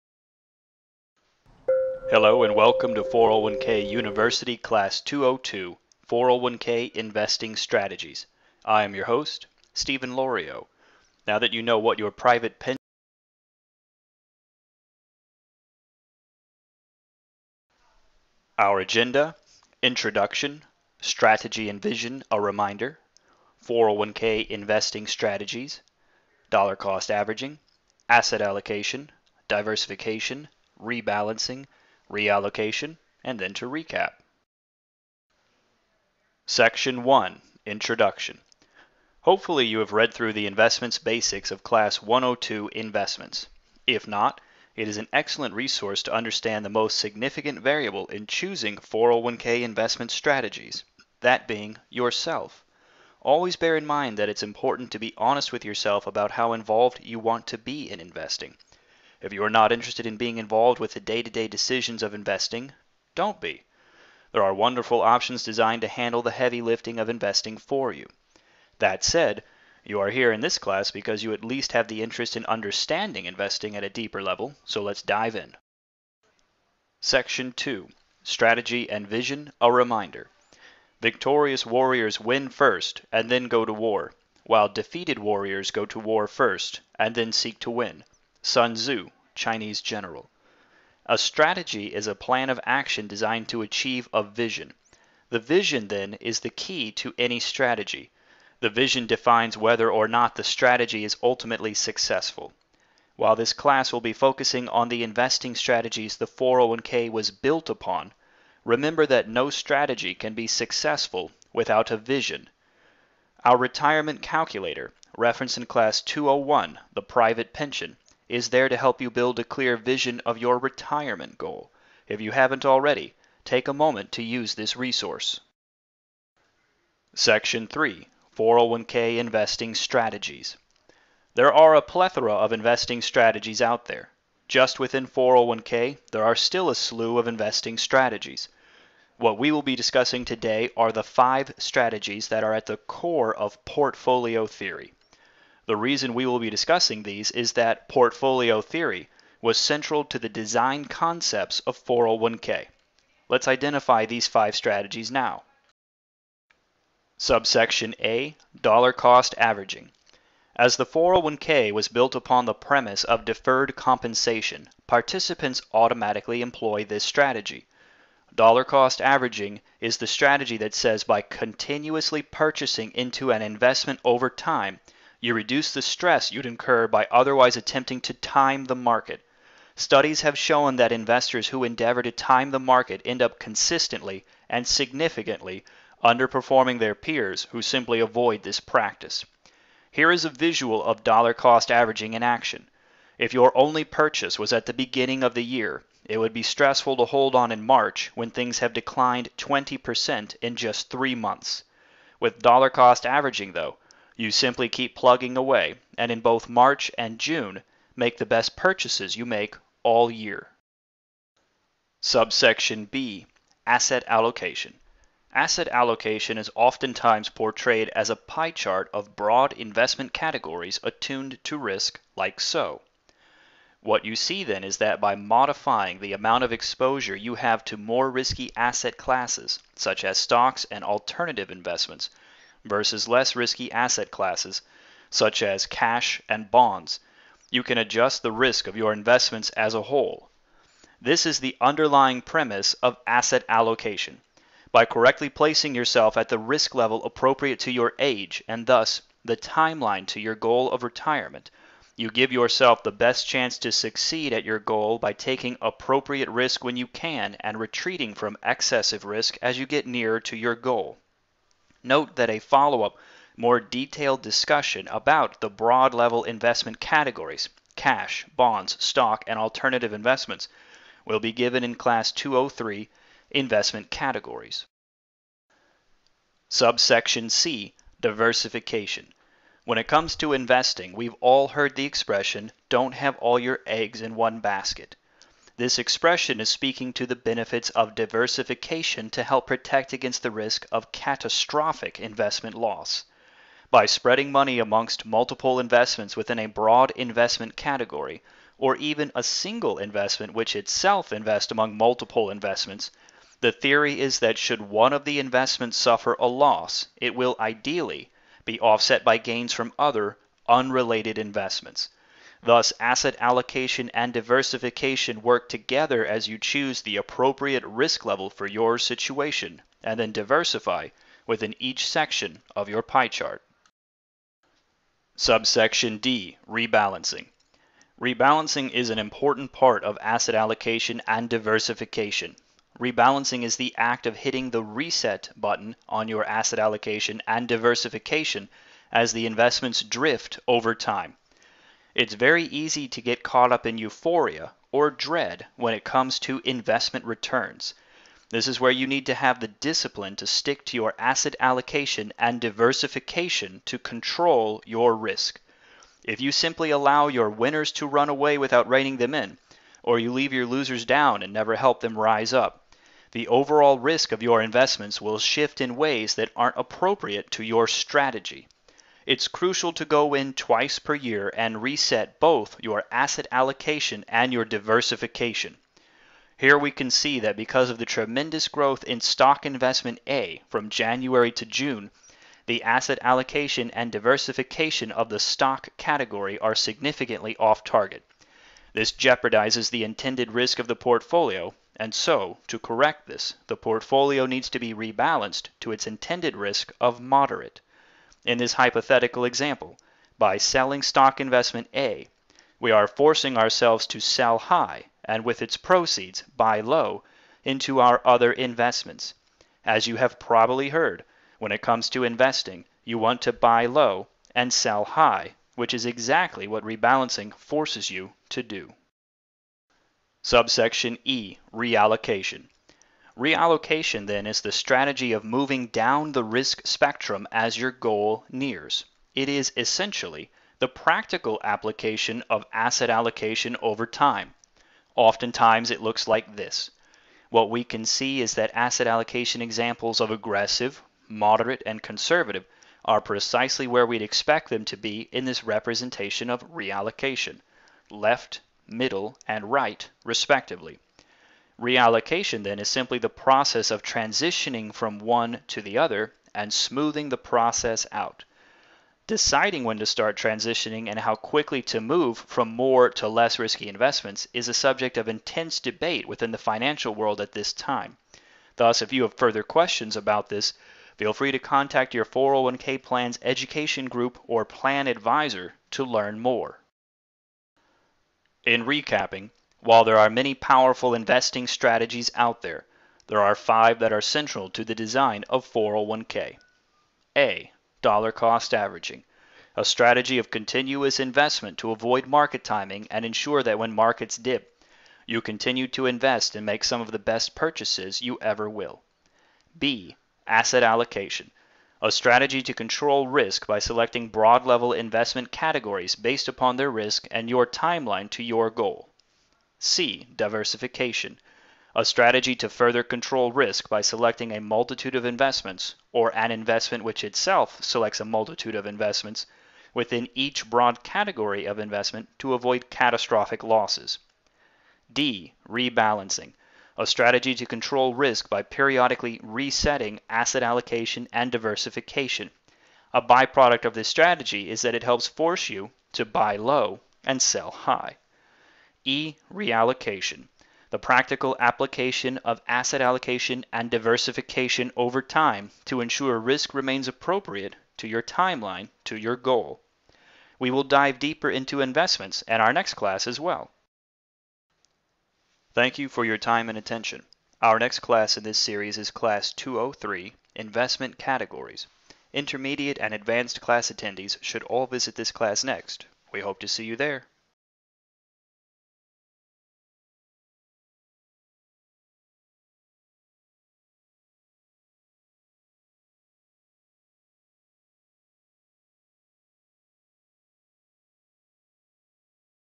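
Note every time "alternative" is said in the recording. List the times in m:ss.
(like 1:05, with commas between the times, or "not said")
3:50, 4:29.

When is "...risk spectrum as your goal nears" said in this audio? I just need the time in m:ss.
7:06.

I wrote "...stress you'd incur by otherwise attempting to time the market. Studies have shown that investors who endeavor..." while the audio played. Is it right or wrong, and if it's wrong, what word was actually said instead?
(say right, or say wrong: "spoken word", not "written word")
right.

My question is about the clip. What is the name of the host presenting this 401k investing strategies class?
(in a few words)
Stephen Lorio.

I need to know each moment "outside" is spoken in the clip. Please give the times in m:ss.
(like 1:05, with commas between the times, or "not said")
not said.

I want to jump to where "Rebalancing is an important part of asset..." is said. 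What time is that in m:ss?
5:28.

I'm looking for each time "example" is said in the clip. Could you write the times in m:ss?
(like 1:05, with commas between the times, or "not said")
6:39, 7:19.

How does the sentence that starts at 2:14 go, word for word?
Just within 401k, there are still a slew of investing strategies.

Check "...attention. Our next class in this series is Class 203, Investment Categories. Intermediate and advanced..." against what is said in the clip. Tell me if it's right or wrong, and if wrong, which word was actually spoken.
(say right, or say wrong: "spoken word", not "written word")
right.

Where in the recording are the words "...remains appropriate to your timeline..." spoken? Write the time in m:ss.
9:06.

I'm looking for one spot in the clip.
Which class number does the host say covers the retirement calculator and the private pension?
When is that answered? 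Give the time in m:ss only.
1:56.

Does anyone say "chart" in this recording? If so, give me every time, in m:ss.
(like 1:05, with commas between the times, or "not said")
3:38, 5:23.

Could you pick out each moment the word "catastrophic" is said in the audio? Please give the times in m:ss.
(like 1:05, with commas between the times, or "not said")
4:50, 8:42.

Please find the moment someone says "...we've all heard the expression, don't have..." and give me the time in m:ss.
4:40.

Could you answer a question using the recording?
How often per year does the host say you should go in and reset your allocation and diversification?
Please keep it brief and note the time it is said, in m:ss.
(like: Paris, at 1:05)
twice, at 6:10.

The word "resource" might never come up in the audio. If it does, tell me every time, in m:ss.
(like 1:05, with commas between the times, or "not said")
0:45, 2:04.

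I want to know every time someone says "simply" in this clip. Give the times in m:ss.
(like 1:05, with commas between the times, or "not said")
3:07, 3:24, 5:56, 7:32.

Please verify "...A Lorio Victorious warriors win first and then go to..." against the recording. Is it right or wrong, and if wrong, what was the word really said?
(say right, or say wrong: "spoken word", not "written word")
wrong: "Reminder", not "Lorio".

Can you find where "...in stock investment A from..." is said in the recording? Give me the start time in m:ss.
6:18.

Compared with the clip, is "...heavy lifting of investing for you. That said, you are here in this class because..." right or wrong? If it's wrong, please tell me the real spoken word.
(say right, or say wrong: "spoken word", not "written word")
right.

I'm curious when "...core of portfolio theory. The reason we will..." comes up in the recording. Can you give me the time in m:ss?
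2:22.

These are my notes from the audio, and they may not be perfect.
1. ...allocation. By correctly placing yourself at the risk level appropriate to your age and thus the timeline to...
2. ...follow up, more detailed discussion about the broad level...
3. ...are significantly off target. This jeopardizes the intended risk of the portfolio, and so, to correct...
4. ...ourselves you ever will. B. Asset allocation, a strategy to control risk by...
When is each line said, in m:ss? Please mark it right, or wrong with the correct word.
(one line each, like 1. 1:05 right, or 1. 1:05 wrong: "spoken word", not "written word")
1. 4:03 right
2. 4:22 right
3. 6:26 right
4. 8:17 wrong: "purchases", not "ourselves".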